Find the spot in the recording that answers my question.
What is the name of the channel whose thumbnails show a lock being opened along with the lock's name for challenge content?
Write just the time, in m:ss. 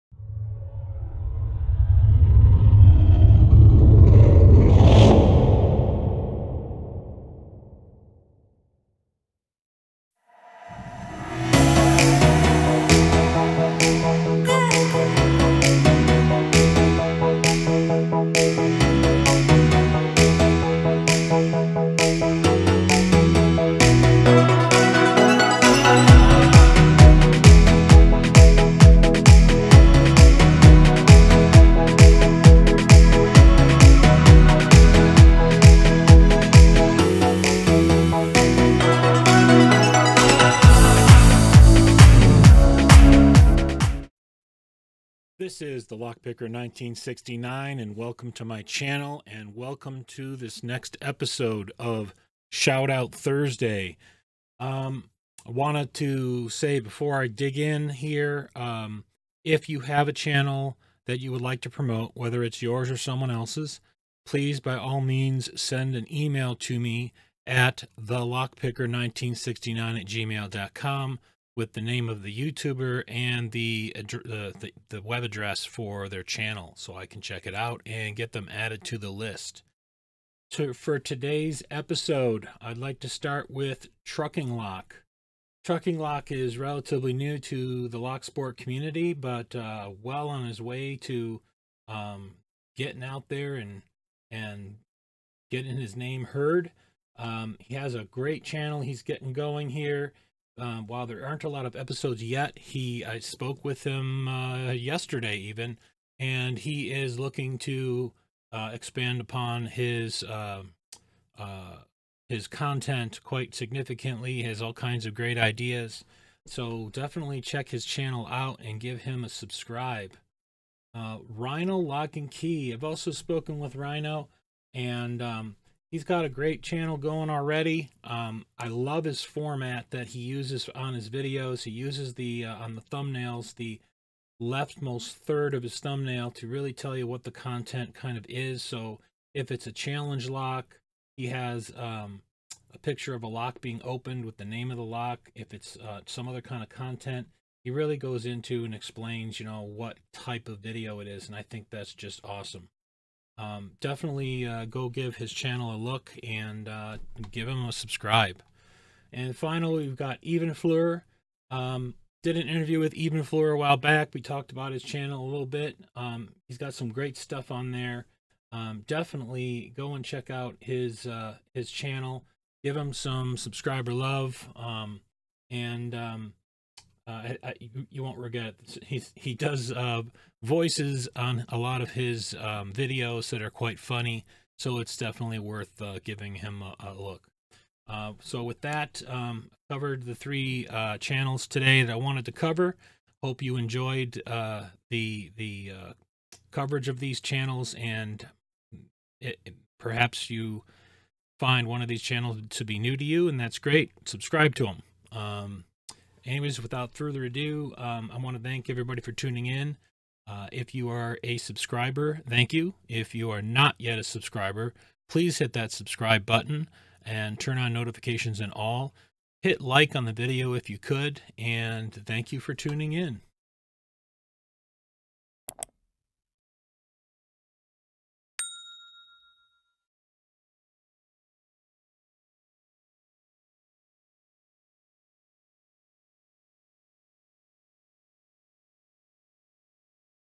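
2:01.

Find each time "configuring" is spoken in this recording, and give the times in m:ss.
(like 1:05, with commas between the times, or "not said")
not said.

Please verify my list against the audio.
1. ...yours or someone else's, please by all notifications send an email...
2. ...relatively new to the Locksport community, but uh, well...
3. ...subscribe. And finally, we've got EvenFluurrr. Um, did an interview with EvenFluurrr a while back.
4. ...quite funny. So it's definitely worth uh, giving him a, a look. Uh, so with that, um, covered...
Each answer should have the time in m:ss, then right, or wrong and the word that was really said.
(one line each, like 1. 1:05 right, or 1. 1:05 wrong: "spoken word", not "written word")
1. 1:02 wrong: "means", not "notifications"
2. 1:26 right
3. 2:37 right
4. 3:03 right.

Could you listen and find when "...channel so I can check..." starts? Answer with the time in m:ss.
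1:16.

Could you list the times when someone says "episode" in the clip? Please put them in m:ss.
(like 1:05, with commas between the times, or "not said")
0:51, 1:21, 1:41.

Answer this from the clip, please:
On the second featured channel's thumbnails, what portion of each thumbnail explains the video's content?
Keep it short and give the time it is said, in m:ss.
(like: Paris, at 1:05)
leftmost third, at 2:14.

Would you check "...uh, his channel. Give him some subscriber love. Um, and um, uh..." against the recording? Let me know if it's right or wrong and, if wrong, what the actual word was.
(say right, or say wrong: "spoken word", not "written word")
right.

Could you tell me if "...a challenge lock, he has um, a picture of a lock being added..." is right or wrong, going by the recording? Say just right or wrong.
wrong.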